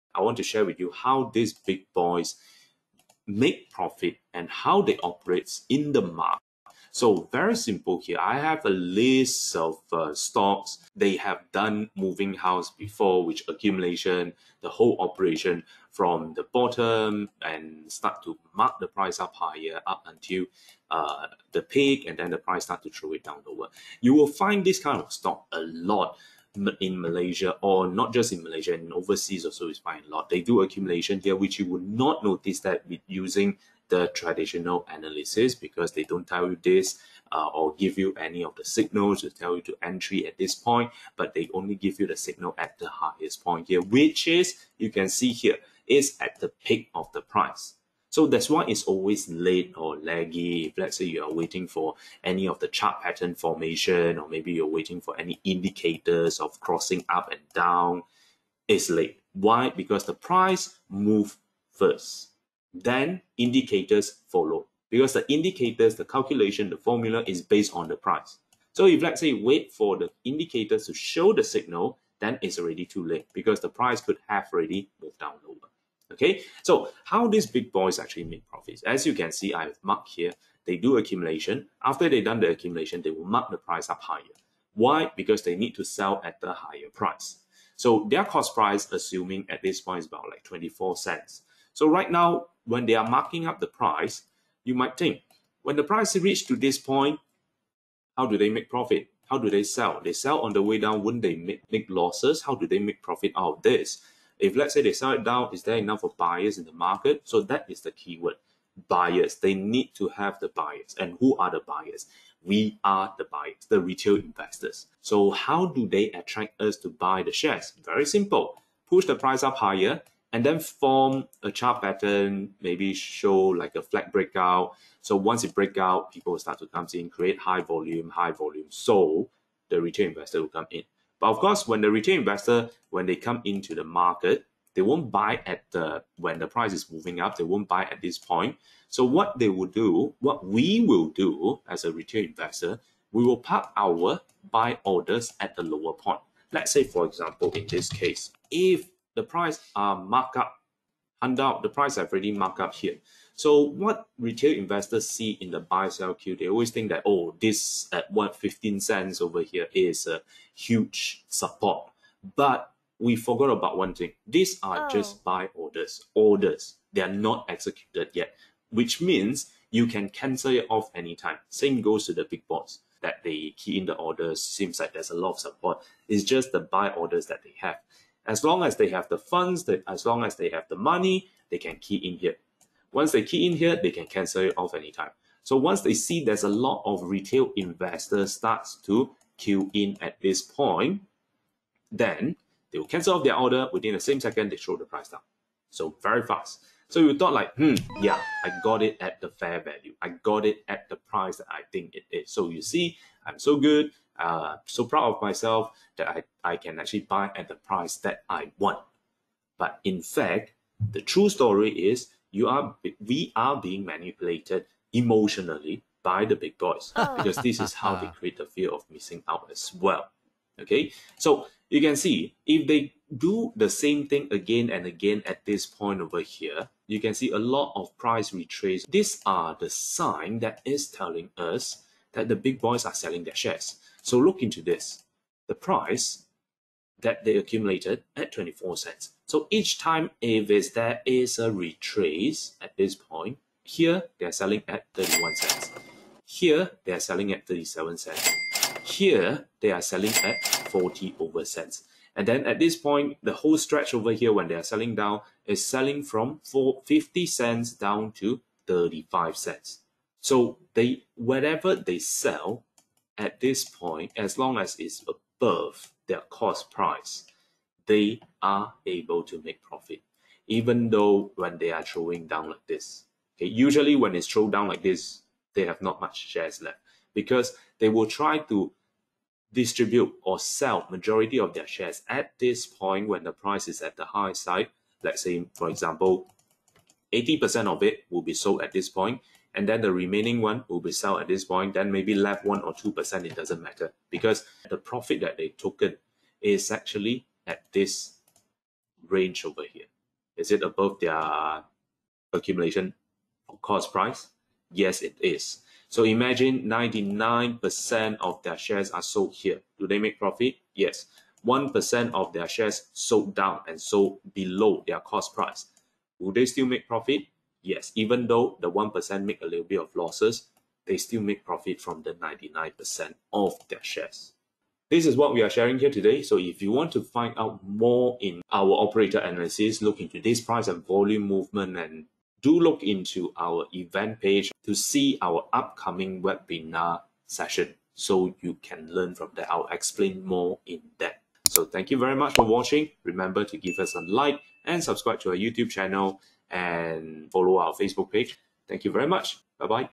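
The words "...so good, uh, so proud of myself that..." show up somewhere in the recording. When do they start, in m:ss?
3:23.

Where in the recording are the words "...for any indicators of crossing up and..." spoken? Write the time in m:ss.
0:54.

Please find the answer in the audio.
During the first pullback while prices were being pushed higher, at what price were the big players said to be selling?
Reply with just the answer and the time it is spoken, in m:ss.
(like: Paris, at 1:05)
31 cents, at 4:04.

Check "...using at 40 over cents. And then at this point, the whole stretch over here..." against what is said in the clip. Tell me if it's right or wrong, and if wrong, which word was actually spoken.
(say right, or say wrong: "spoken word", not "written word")
wrong: "selling", not "using".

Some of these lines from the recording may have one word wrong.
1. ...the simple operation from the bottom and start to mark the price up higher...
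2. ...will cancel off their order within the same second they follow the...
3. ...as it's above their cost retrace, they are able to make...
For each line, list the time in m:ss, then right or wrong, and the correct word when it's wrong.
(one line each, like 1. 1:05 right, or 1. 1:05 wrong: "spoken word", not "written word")
1. 0:14 wrong: "whole", not "simple"
2. 3:12 wrong: "throw", not "follow"
3. 4:24 wrong: "price", not "retrace".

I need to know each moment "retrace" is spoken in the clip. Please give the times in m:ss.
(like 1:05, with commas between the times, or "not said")
3:48, 4:01.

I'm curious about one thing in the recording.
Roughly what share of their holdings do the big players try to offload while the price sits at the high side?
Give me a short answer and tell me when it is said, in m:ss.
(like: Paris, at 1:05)
80%, at 4:47.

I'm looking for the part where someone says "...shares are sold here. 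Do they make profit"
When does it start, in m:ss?
5:08.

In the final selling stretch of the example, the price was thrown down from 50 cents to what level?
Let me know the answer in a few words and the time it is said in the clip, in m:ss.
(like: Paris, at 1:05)
35 cents, at 4:18.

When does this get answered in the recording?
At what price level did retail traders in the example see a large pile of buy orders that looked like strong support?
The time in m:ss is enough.
2:38.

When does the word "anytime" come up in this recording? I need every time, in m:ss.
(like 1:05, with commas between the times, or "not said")
2:50, 3:04.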